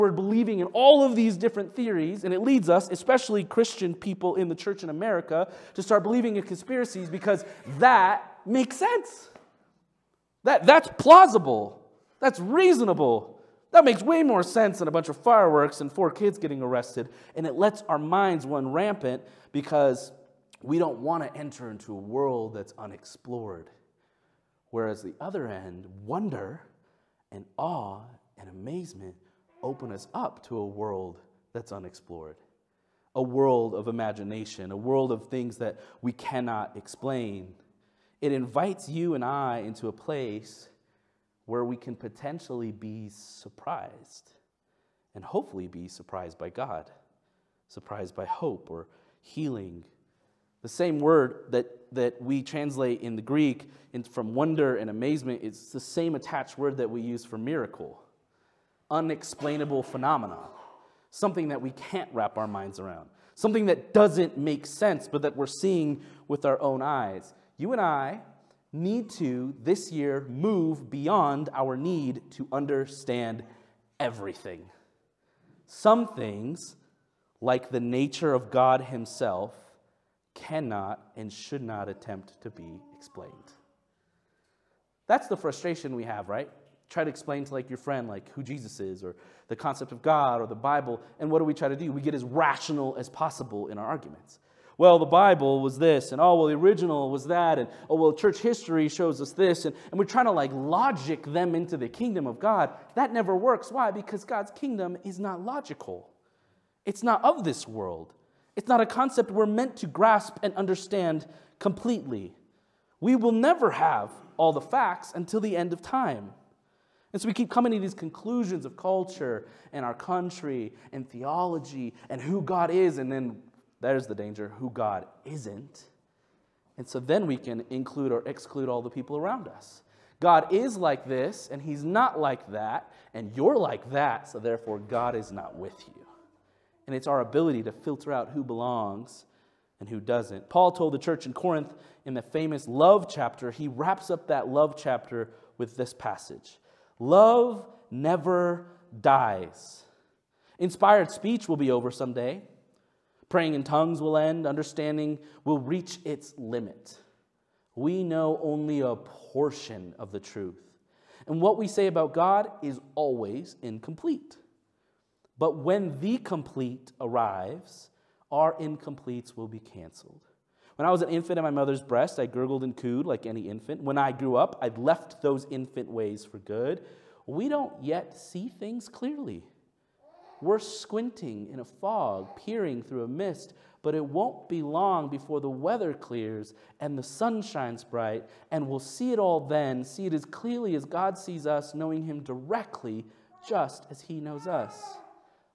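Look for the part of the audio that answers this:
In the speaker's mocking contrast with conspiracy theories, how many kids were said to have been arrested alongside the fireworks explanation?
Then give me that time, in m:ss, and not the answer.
0:15.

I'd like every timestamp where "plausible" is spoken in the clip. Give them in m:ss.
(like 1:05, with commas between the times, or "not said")
0:10.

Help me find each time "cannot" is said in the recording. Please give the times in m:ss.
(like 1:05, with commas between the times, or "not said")
0:36, 1:20.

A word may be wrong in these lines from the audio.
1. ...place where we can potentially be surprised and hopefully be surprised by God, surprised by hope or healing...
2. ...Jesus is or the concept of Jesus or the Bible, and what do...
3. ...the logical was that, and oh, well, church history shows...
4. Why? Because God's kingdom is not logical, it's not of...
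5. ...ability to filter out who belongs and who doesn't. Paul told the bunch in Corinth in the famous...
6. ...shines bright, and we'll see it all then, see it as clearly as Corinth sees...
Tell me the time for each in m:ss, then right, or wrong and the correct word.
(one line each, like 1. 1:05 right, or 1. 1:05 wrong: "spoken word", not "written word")
1. 0:39 right
2. 1:28 wrong: "God", not "Jesus"
3. 1:36 wrong: "original", not "logical"
4. 1:43 right
5. 2:17 wrong: "church", not "bunch"
6. 3:07 wrong: "God", not "Corinth".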